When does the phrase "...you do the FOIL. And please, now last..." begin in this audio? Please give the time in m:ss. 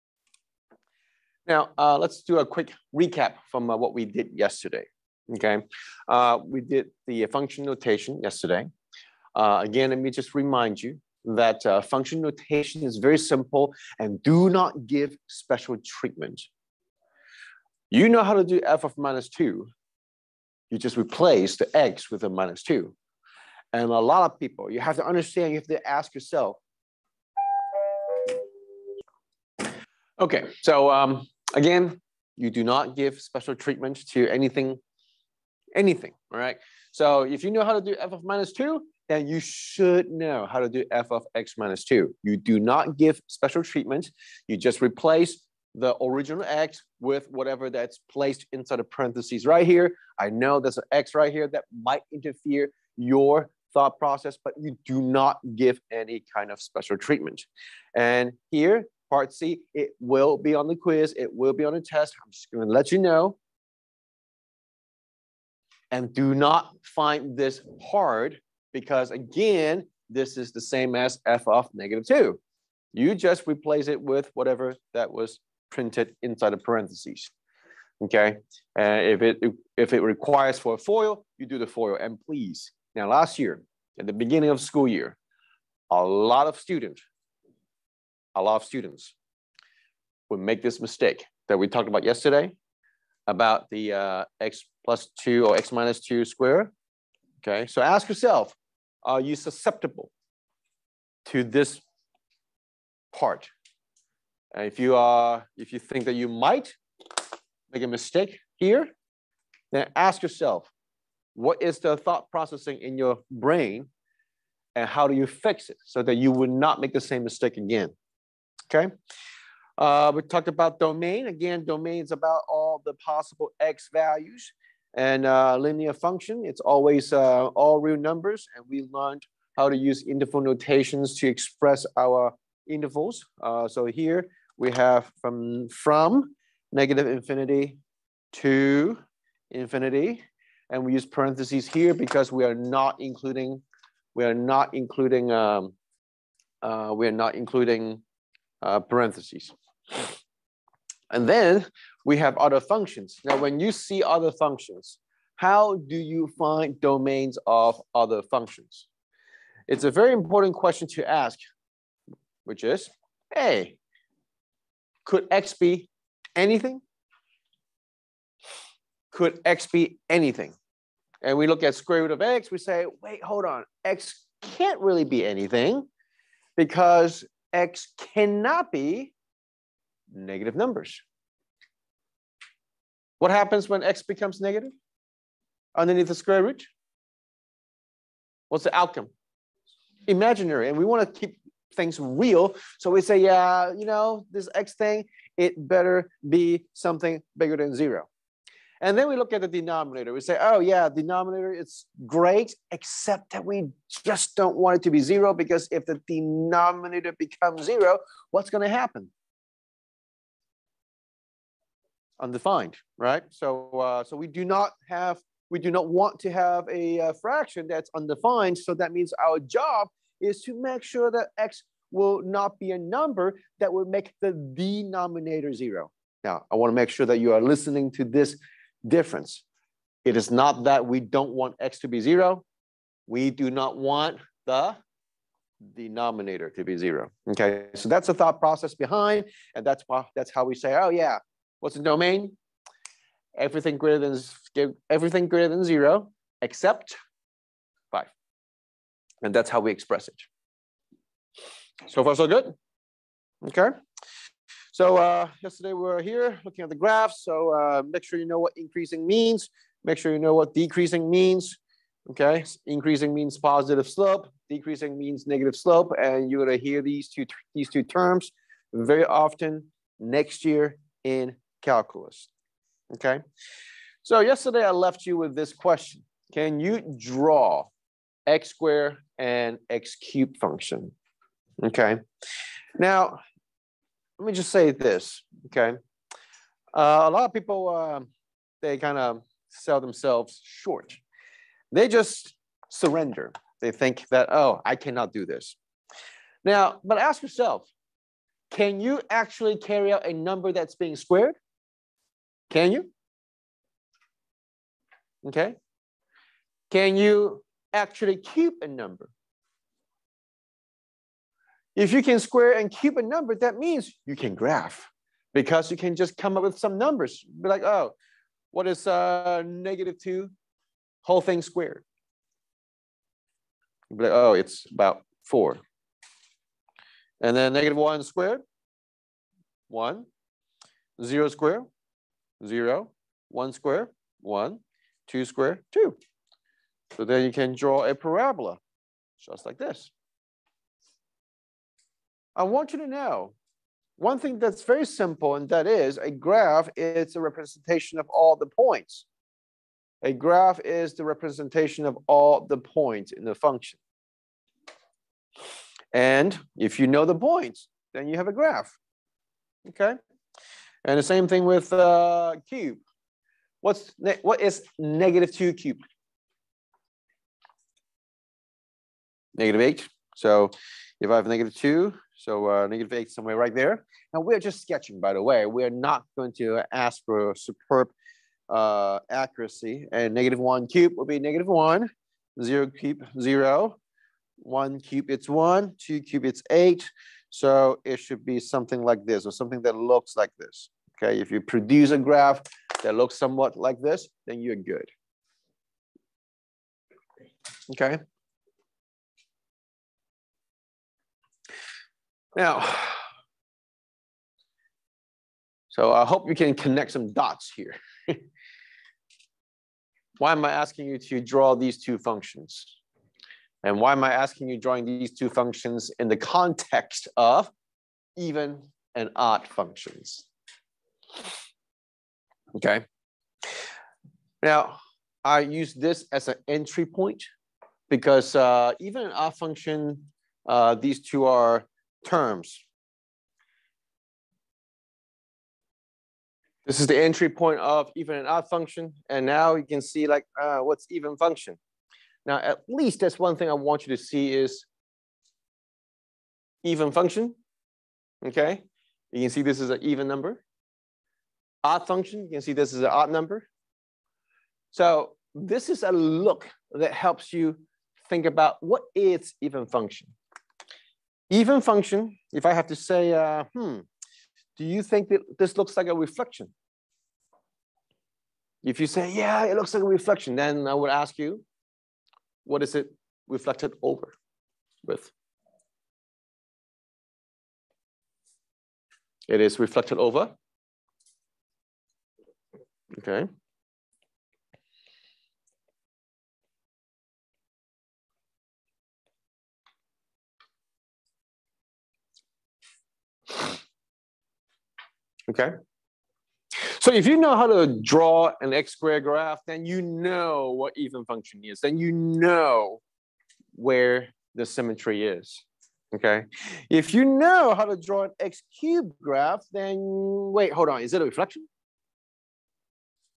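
1:21.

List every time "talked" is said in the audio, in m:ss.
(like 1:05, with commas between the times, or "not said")
1:31, 2:00.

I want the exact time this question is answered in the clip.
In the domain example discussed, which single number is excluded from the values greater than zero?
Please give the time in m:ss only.
4:07.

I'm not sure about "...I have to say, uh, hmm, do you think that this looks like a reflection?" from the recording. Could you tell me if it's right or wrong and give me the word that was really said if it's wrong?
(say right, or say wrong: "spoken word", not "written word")
right.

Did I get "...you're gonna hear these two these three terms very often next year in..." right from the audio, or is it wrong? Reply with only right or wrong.
wrong.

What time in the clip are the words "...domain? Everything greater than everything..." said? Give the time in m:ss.
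4:01.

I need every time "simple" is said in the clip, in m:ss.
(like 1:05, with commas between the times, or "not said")
0:13, 5:44.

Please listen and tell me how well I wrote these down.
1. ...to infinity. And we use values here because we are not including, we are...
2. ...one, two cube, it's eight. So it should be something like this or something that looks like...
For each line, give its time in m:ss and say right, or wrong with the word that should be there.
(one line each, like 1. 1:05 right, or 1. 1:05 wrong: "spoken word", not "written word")
1. 2:18 wrong: "parentheses", not "values"
2. 6:25 right.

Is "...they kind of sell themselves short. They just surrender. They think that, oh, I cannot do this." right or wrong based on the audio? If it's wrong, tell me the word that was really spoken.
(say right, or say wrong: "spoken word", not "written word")
right.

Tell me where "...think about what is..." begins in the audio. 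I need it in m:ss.
7:38.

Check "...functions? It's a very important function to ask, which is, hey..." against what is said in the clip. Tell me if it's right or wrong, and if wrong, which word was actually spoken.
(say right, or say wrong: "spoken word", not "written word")
wrong: "question", not "function".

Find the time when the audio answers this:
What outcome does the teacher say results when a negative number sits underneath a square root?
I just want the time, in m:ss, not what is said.
3:10.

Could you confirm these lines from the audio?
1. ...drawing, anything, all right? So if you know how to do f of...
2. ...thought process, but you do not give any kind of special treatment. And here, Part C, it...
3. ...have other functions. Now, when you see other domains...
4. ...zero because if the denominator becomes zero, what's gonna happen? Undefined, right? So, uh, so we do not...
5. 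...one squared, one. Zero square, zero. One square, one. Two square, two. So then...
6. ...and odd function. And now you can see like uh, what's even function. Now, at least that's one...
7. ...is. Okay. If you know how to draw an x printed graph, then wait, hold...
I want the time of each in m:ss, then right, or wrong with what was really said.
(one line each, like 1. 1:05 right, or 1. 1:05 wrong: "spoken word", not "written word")
1. 0:34 wrong: "anything", not "drawing"
2. 0:53 right
3. 2:32 wrong: "functions", not "domains"
4. 3:24 right
5. 5:27 right
6. 7:18 right
7. 8:25 wrong: "cubed", not "printed".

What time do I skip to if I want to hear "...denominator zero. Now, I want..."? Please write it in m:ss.
3:44.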